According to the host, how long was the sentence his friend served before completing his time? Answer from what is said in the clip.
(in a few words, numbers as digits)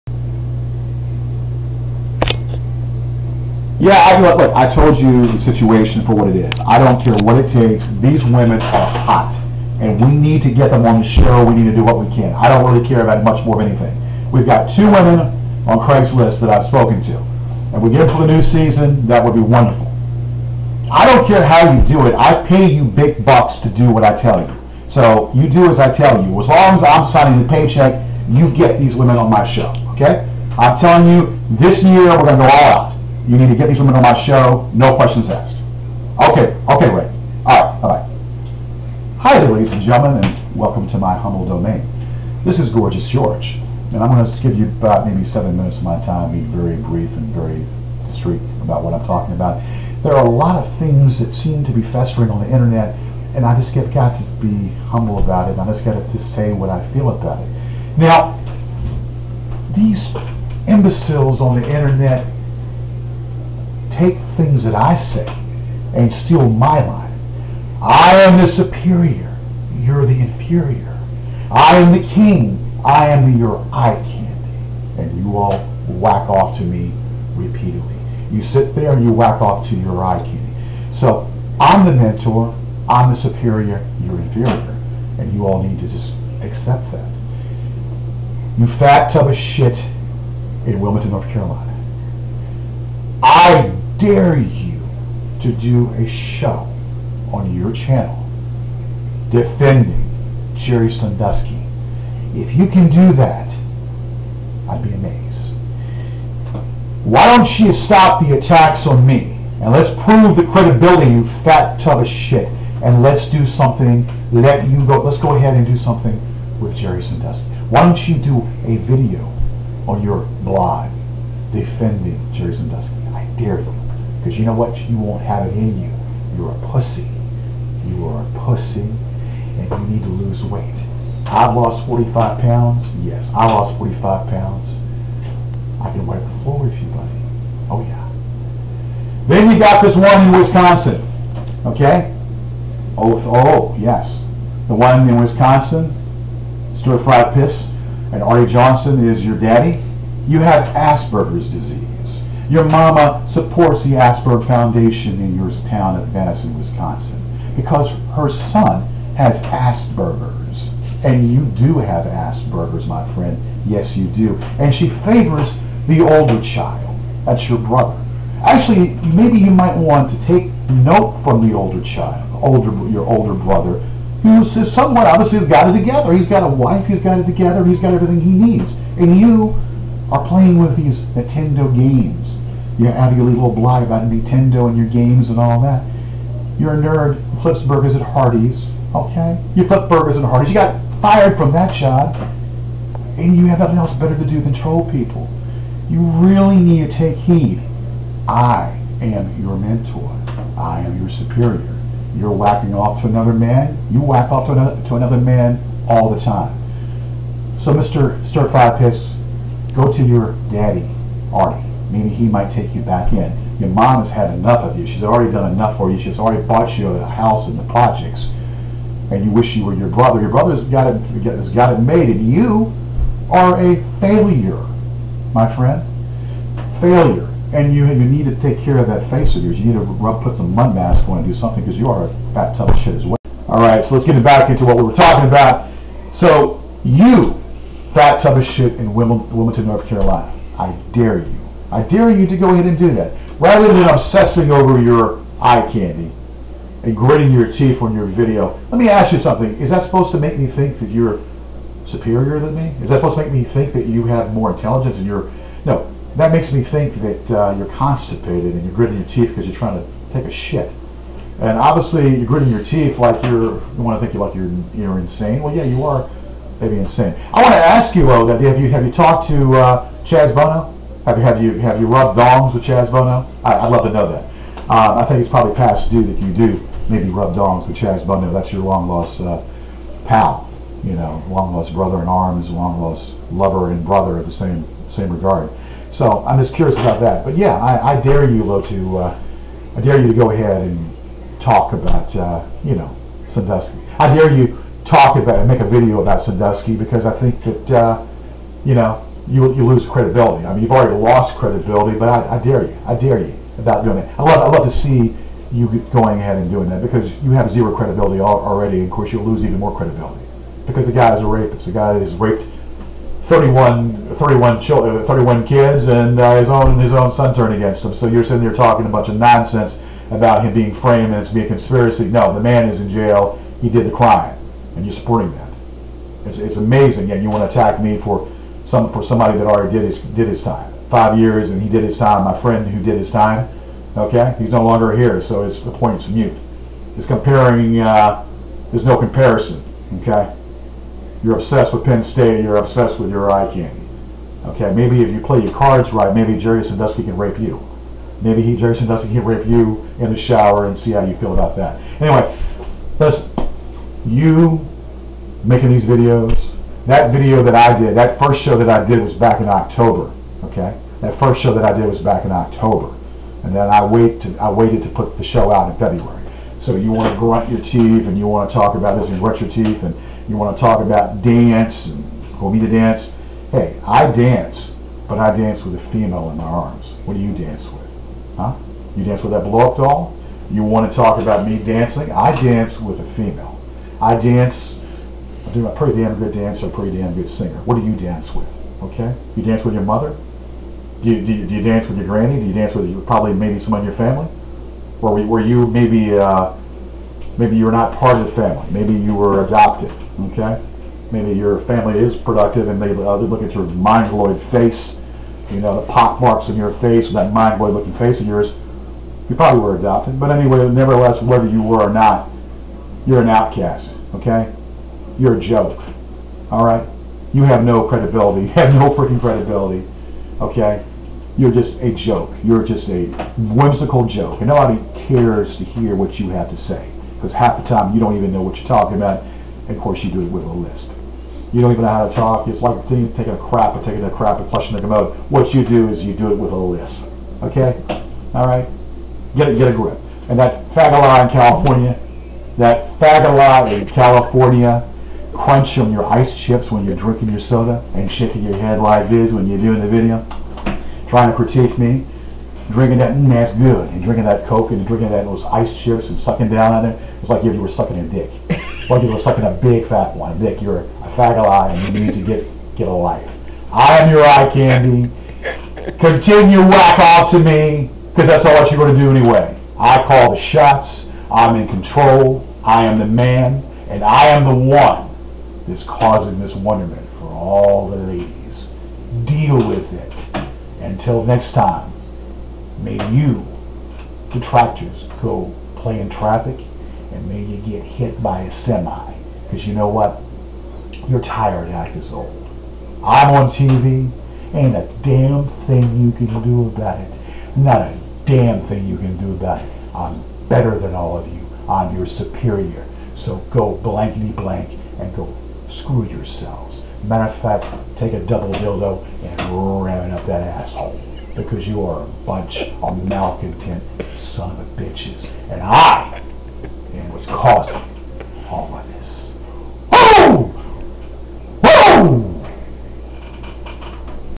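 5 years.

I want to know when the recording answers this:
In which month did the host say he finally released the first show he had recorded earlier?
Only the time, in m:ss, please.
6:05.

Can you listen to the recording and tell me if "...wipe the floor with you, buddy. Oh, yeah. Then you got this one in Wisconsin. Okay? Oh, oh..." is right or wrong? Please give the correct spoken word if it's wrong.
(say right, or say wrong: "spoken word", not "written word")
right.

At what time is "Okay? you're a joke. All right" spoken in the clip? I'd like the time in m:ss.
6:54.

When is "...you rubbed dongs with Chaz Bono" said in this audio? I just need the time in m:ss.
4:31.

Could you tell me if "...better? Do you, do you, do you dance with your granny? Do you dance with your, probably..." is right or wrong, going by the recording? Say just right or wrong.
wrong.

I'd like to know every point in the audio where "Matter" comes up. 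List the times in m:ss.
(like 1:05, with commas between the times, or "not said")
8:27.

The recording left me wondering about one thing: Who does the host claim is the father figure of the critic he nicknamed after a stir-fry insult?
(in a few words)
Artie Johnson.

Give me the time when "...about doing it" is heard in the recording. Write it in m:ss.
5:03.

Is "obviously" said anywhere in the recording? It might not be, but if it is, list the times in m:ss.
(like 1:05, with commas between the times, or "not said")
2:55, 4:21.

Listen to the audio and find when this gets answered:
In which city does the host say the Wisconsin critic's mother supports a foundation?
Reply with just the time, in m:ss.
2:36.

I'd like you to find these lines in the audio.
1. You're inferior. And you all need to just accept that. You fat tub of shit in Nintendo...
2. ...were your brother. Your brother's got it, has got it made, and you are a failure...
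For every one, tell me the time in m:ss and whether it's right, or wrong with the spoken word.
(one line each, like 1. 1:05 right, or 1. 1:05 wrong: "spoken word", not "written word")
1. 1:24 wrong: "Wilmington", not "Nintendo"
2. 3:39 right.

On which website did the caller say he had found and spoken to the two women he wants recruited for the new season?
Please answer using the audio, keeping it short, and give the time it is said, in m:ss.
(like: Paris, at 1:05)
Craigslist, at 0:15.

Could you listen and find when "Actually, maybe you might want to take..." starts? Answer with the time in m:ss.
2:48.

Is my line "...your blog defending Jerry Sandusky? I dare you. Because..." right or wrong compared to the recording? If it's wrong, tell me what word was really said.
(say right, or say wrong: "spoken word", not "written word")
right.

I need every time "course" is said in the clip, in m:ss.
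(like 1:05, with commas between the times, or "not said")
5:08, 7:09.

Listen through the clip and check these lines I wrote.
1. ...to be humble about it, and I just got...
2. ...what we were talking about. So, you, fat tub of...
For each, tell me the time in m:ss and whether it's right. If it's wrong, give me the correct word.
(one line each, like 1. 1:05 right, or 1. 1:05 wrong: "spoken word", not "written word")
1. 0:54 right
2. 3:54 right.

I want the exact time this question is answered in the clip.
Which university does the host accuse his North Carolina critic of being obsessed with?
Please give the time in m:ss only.
5:41.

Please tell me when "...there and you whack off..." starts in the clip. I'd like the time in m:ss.
1:18.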